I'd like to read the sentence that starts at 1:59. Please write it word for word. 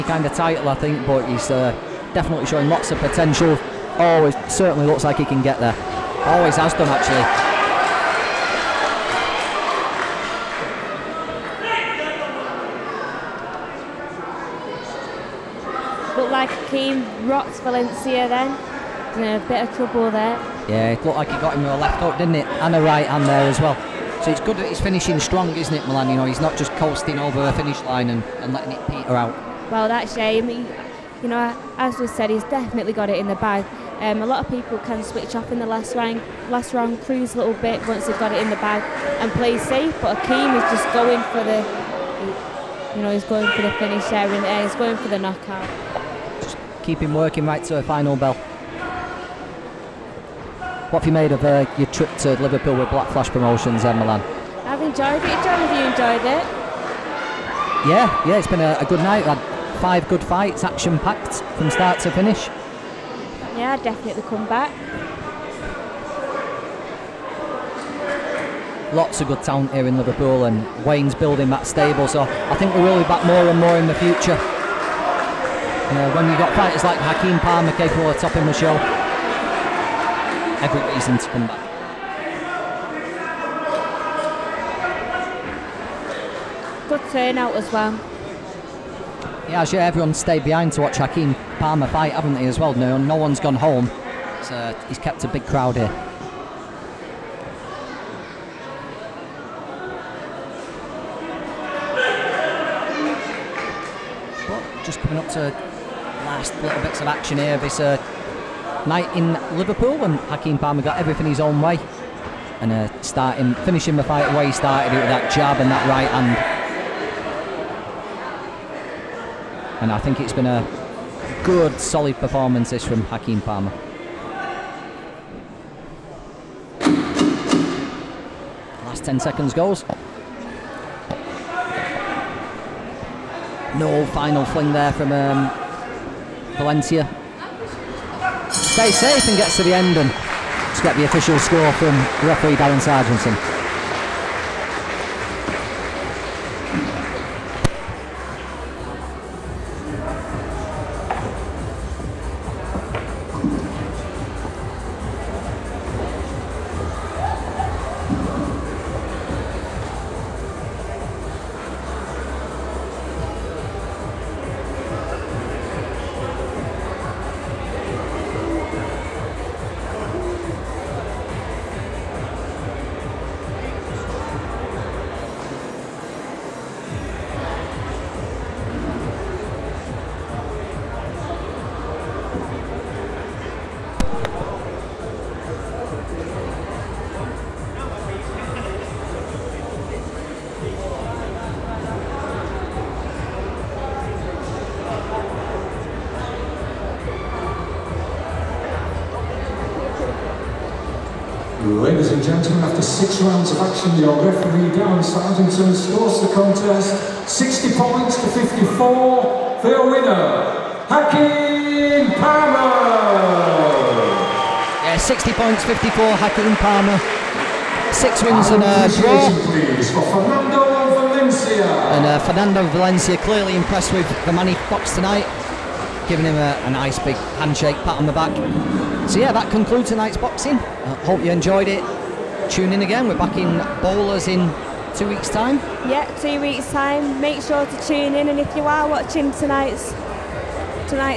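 And I think it's been a good, solid performance this from Hakeem Palmer.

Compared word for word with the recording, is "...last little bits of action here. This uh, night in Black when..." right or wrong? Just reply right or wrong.
wrong.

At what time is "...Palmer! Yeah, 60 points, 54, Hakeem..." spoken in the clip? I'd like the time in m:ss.
3:32.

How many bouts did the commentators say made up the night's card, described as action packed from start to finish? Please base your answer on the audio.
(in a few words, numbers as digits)
5.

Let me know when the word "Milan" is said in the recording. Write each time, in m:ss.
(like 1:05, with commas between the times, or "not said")
0:25, 0:53.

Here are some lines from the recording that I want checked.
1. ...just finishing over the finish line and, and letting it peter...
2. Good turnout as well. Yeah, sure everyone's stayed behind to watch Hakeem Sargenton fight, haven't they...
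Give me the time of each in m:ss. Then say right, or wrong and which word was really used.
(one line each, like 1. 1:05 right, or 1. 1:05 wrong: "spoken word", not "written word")
1. 0:26 wrong: "coasting", not "finishing"
2. 1:26 wrong: "Palmer", not "Sargenton".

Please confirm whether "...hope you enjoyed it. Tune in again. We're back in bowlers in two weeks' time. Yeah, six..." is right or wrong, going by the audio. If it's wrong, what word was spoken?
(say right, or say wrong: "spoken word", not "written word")
wrong: "two", not "six".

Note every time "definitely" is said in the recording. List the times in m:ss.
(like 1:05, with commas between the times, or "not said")
0:02, 0:32, 1:03.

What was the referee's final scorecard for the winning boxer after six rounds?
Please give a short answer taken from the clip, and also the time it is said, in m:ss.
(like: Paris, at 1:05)
60 points to 54, at 3:27.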